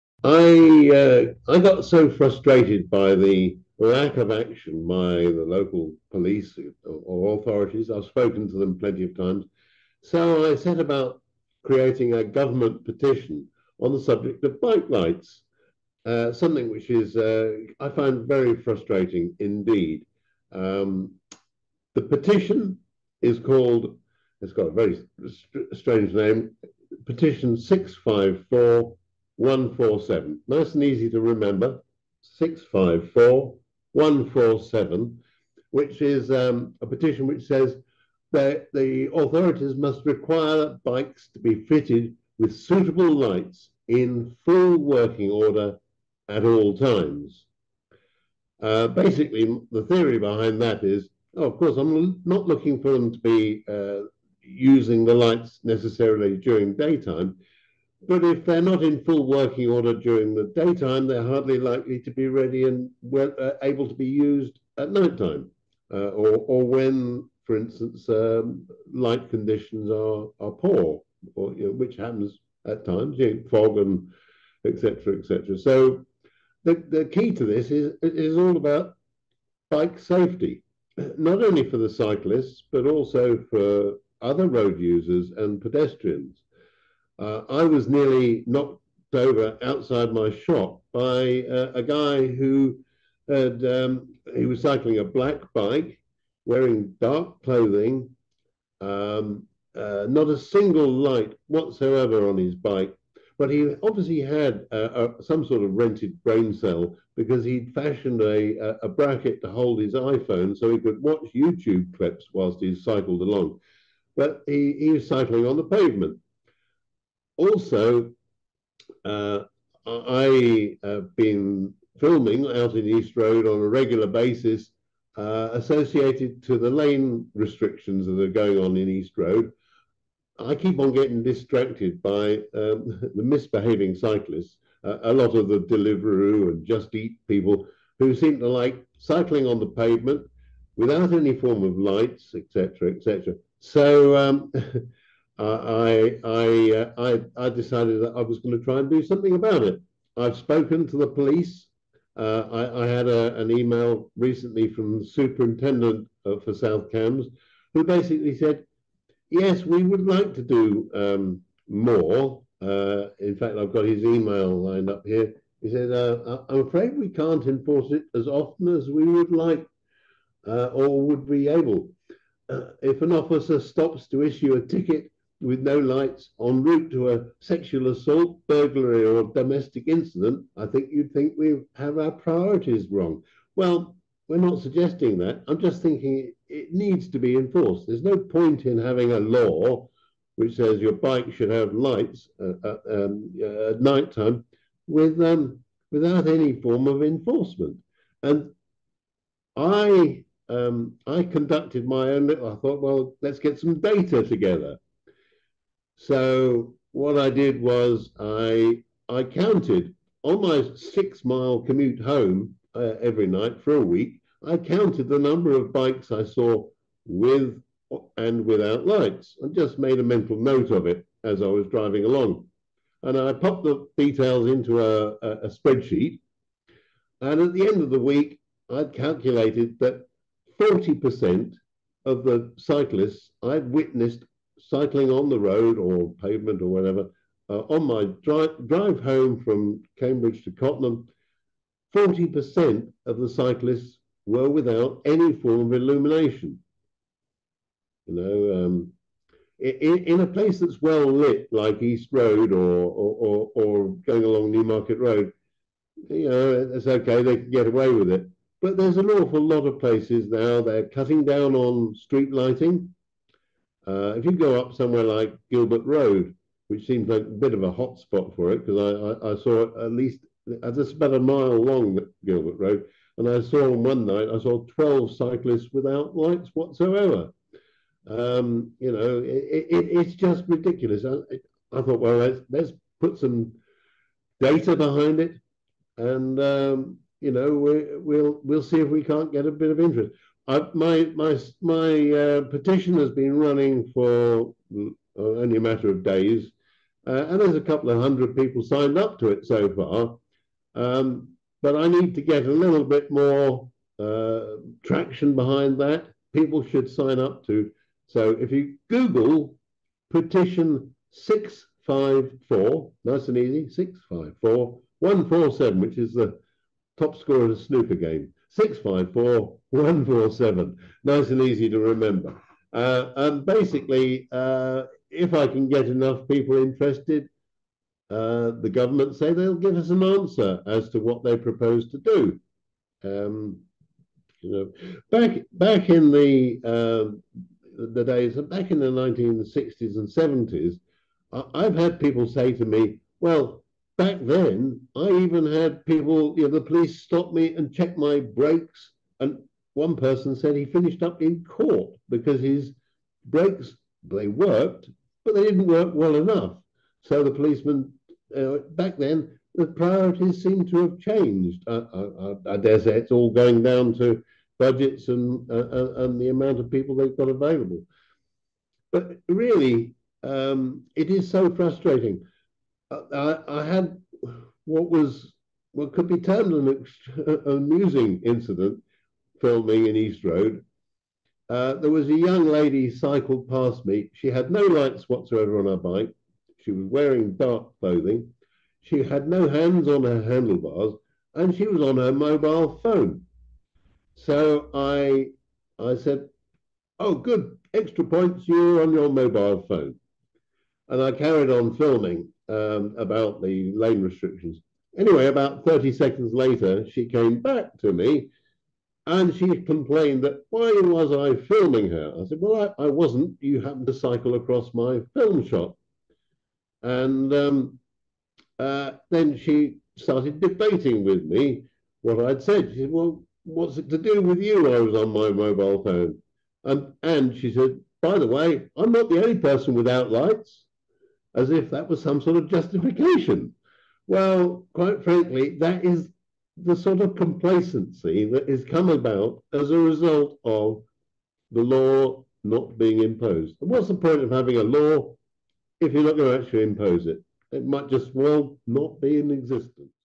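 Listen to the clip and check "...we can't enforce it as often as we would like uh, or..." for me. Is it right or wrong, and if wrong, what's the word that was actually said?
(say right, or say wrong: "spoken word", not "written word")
right.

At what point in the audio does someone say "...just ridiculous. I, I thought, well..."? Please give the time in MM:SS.
04:40.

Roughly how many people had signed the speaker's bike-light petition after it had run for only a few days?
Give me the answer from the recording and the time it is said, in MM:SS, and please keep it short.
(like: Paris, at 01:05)
A couple of hundred, at 04:57.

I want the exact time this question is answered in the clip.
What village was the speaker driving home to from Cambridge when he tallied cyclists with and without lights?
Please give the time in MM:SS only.
04:00.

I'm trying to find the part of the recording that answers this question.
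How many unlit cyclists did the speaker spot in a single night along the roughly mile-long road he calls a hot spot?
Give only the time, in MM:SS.
04:34.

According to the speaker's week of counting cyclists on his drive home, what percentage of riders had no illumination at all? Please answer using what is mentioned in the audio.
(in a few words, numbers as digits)
40%.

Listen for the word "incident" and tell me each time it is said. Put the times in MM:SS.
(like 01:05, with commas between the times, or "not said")
02:59, 06:18.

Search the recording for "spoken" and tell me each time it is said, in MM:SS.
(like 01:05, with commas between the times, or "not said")
00:08, 02:30.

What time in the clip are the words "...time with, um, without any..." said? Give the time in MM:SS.
03:14.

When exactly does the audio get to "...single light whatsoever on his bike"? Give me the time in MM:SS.
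01:40.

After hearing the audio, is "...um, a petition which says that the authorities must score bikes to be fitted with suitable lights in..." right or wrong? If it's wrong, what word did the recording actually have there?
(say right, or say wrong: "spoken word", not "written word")
wrong: "require", not "score".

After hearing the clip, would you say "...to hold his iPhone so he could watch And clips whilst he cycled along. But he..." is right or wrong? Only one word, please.
wrong.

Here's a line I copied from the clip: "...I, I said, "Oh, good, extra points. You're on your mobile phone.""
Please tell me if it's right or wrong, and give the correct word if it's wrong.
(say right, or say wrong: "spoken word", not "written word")
right.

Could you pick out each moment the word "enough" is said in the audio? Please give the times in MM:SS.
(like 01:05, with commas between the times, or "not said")
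05:25, 05:56.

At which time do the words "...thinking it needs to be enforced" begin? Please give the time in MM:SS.
03:05.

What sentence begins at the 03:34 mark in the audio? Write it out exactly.
I counted the number of bikes I saw with and without lights.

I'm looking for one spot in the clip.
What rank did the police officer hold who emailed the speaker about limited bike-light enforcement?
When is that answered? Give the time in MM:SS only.
02:35.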